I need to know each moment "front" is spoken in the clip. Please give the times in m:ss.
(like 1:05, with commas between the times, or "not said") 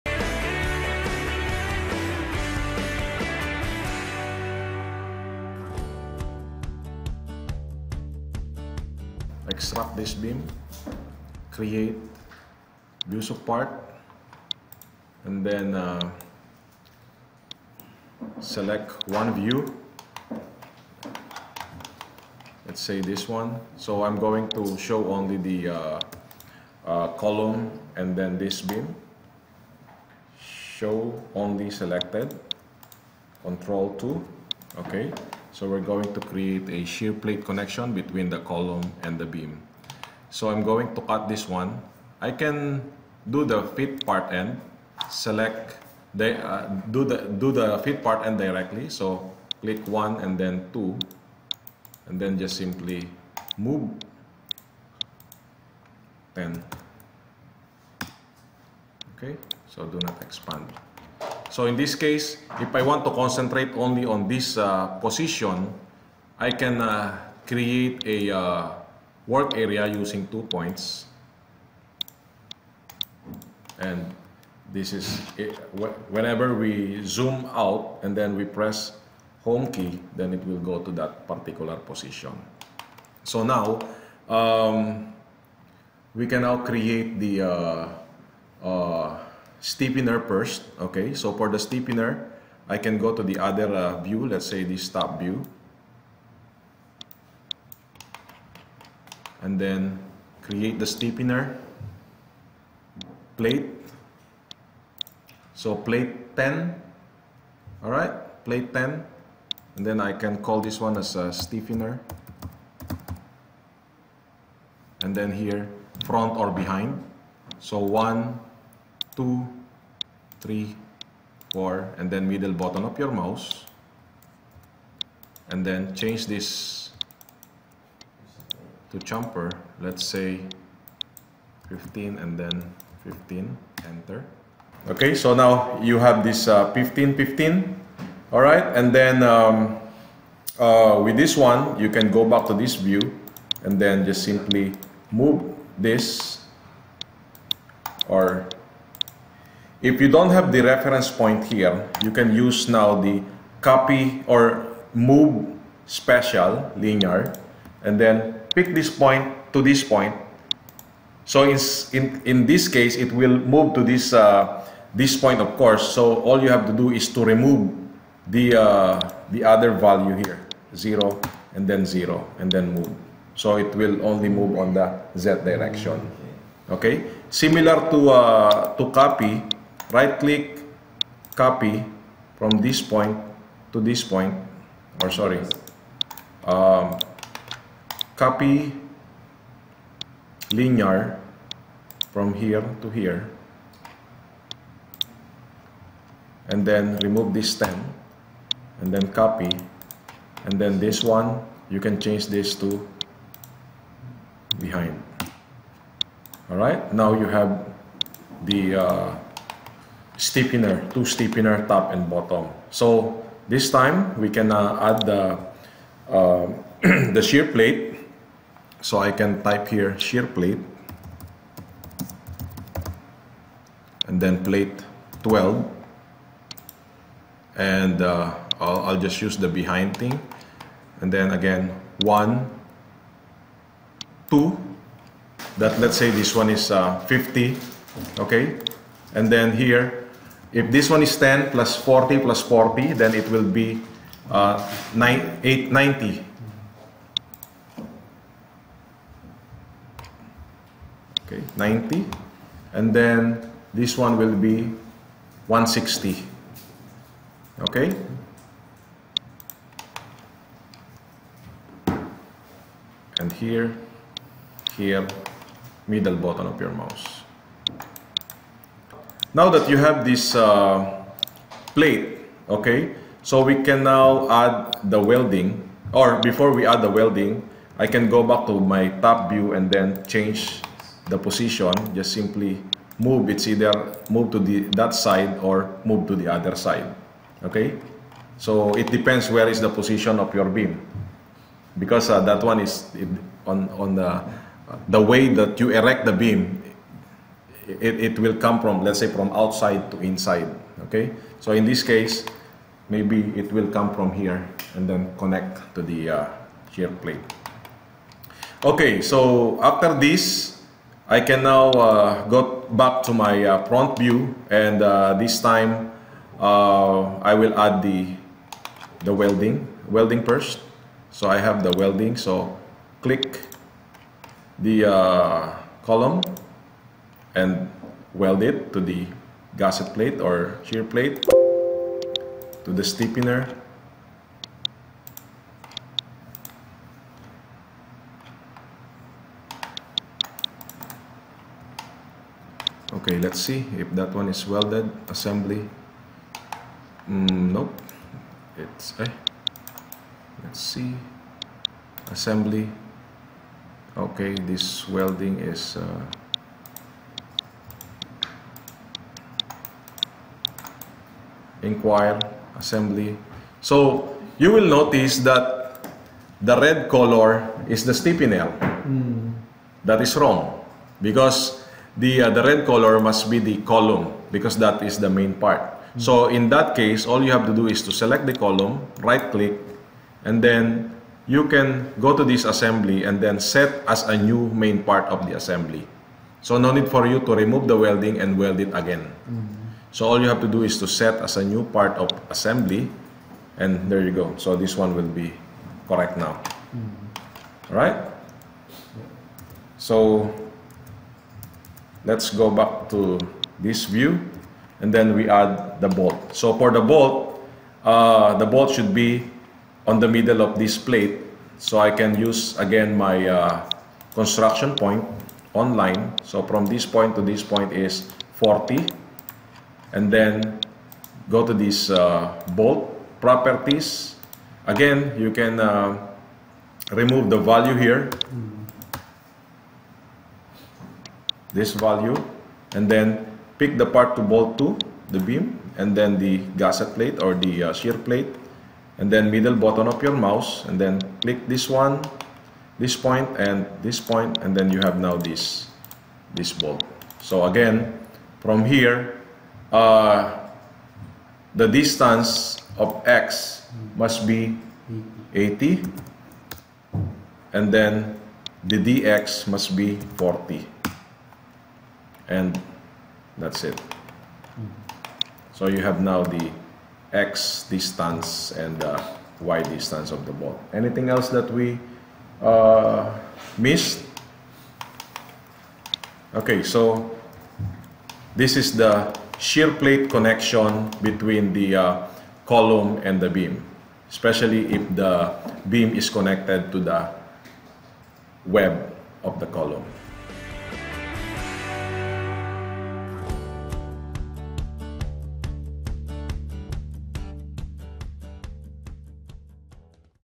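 1:56, 5:13.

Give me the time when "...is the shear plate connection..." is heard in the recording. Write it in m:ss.
7:58.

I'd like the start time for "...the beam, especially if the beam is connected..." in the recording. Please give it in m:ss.
8:03.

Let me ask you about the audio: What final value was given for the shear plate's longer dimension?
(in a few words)
160.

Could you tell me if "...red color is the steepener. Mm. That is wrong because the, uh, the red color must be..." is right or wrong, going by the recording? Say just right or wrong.
wrong.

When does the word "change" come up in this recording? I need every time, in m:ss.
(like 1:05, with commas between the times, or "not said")
2:05, 3:21, 4:40.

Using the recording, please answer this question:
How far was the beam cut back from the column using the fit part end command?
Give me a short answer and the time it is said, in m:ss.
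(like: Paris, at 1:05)
10, at 0:52.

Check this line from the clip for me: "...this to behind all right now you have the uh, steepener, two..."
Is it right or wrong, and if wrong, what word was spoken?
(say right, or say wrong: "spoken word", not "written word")
right.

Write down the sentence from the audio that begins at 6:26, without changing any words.
So no need for you to remove the welding and weld it again.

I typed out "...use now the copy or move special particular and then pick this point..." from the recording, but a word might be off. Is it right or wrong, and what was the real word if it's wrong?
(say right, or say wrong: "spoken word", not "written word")
wrong: "linear", not "particular".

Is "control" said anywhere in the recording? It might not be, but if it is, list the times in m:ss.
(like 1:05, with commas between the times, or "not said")
0:33.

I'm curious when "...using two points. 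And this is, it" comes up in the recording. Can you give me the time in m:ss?
1:09.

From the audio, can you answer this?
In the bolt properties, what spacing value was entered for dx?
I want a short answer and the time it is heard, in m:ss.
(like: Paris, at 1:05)
40, at 7:38.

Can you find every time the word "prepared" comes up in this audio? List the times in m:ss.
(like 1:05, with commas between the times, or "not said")
not said.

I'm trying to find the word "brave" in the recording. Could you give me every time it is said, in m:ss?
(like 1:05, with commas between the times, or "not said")
not said.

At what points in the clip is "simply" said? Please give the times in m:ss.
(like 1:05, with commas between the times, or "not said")
0:52, 2:24, 4:42.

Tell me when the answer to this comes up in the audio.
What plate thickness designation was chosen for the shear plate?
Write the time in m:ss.
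3:44.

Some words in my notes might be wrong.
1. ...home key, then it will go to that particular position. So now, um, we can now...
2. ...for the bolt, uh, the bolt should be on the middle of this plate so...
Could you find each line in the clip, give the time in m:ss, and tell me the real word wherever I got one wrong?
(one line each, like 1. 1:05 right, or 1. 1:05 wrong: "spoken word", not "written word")
1. 1:19 right
2. 6:46 right.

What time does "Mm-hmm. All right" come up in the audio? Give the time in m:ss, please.
6:36.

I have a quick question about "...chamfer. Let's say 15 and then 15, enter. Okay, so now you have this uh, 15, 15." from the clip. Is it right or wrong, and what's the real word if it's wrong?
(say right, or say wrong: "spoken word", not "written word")
right.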